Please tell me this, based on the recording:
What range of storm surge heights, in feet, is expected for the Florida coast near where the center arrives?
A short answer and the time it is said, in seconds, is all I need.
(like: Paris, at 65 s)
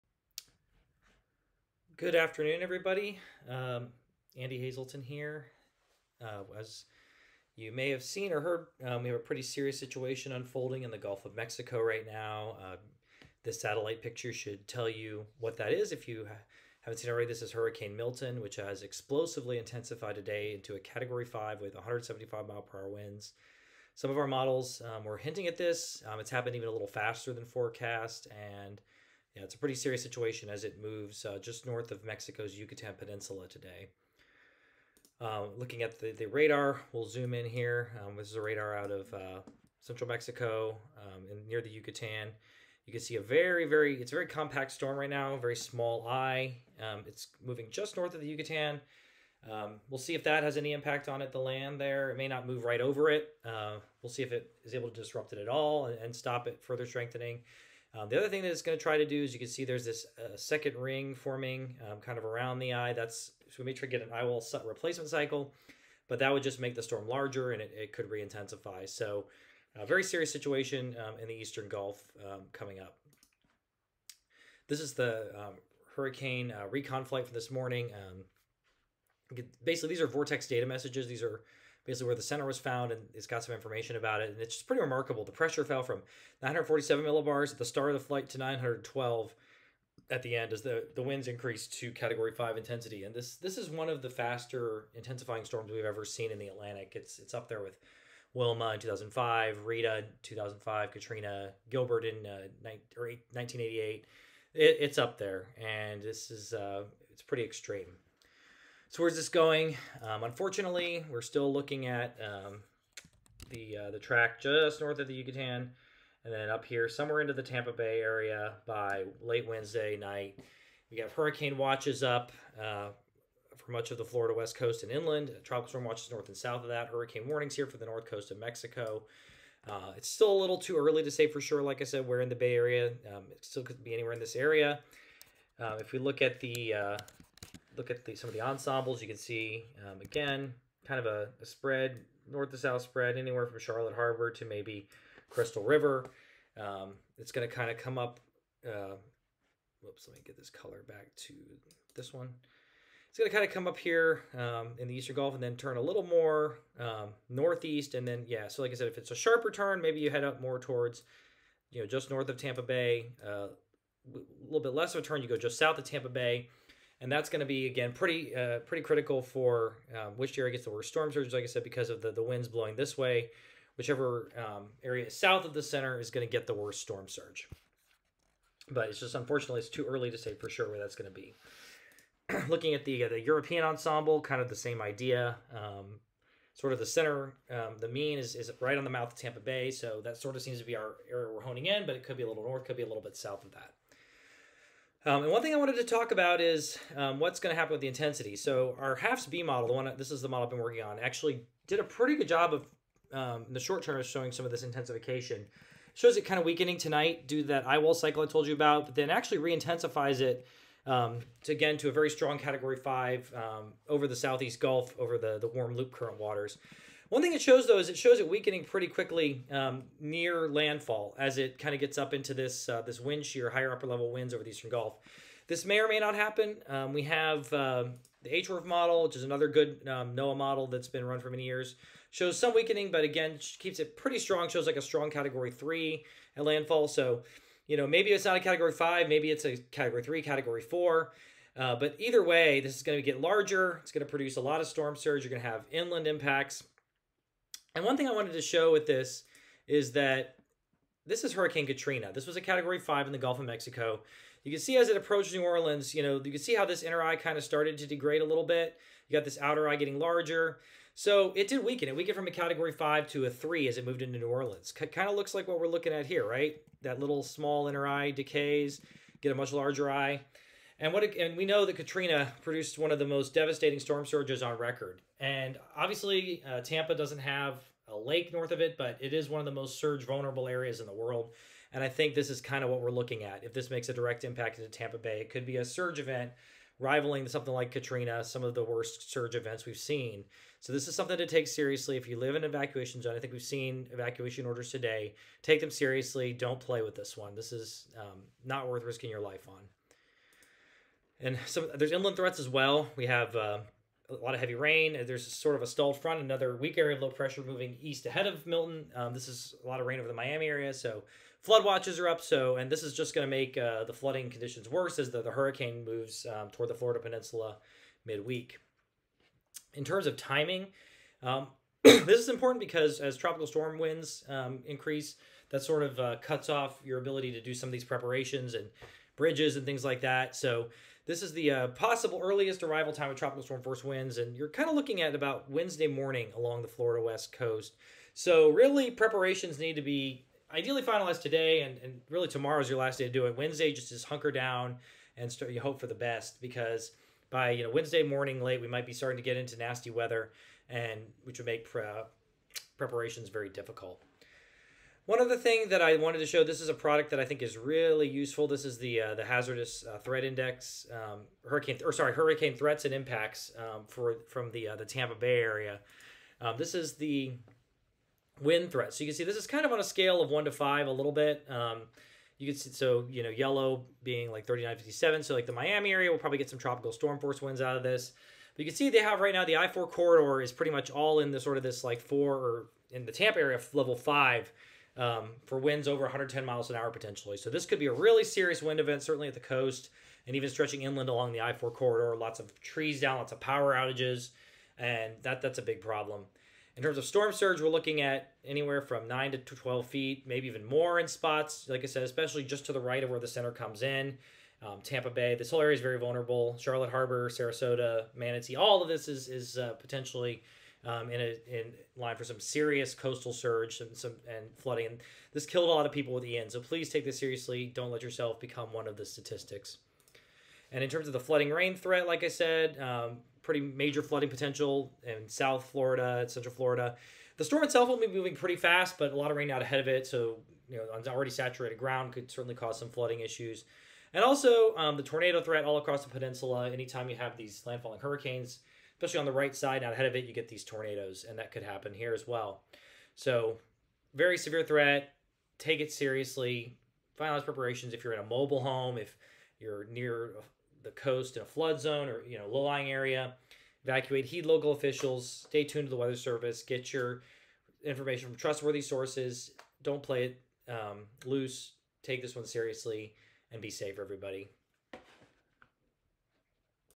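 9 to 12 feet, at 399 s.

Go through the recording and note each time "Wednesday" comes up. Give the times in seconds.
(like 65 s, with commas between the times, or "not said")
119 s, 335 s, 343 s, 347 s.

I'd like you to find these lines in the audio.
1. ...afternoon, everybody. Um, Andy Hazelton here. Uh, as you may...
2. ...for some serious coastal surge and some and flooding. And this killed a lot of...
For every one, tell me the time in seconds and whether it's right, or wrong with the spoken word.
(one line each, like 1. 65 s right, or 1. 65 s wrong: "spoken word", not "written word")
1. 2 s right
2. 412 s right.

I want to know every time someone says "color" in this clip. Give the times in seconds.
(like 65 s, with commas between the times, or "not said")
150 s.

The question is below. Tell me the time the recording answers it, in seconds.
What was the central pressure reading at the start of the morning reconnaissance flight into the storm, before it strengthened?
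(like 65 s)
86 s.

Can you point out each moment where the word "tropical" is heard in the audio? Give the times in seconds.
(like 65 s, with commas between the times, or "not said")
125 s, 323 s, 333 s, 376 s.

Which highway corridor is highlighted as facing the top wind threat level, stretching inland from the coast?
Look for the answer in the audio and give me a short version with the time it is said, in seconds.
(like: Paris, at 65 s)
I-4, at 379 s.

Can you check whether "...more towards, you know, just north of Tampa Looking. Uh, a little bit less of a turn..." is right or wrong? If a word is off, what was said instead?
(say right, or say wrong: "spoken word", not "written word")
wrong: "Bay", not "Looking".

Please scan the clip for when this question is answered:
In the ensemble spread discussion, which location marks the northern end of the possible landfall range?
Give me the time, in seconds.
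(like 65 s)
145 s.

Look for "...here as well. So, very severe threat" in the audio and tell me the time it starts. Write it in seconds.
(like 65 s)
441 s.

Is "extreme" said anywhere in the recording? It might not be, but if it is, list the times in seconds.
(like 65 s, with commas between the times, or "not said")
107 s.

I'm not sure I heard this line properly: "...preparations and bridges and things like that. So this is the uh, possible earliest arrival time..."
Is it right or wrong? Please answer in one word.
right.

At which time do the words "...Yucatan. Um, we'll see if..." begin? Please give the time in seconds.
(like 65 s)
48 s.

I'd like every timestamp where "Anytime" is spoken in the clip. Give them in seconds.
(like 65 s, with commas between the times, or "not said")
436 s.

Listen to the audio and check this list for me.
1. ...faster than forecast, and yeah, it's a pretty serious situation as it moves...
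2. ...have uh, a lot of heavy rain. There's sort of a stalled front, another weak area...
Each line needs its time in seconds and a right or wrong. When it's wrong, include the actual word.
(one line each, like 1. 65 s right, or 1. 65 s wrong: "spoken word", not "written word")
1. 26 s right
2. 303 s right.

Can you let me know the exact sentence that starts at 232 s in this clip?
Shows some weakening, but again, keeps it pretty strong.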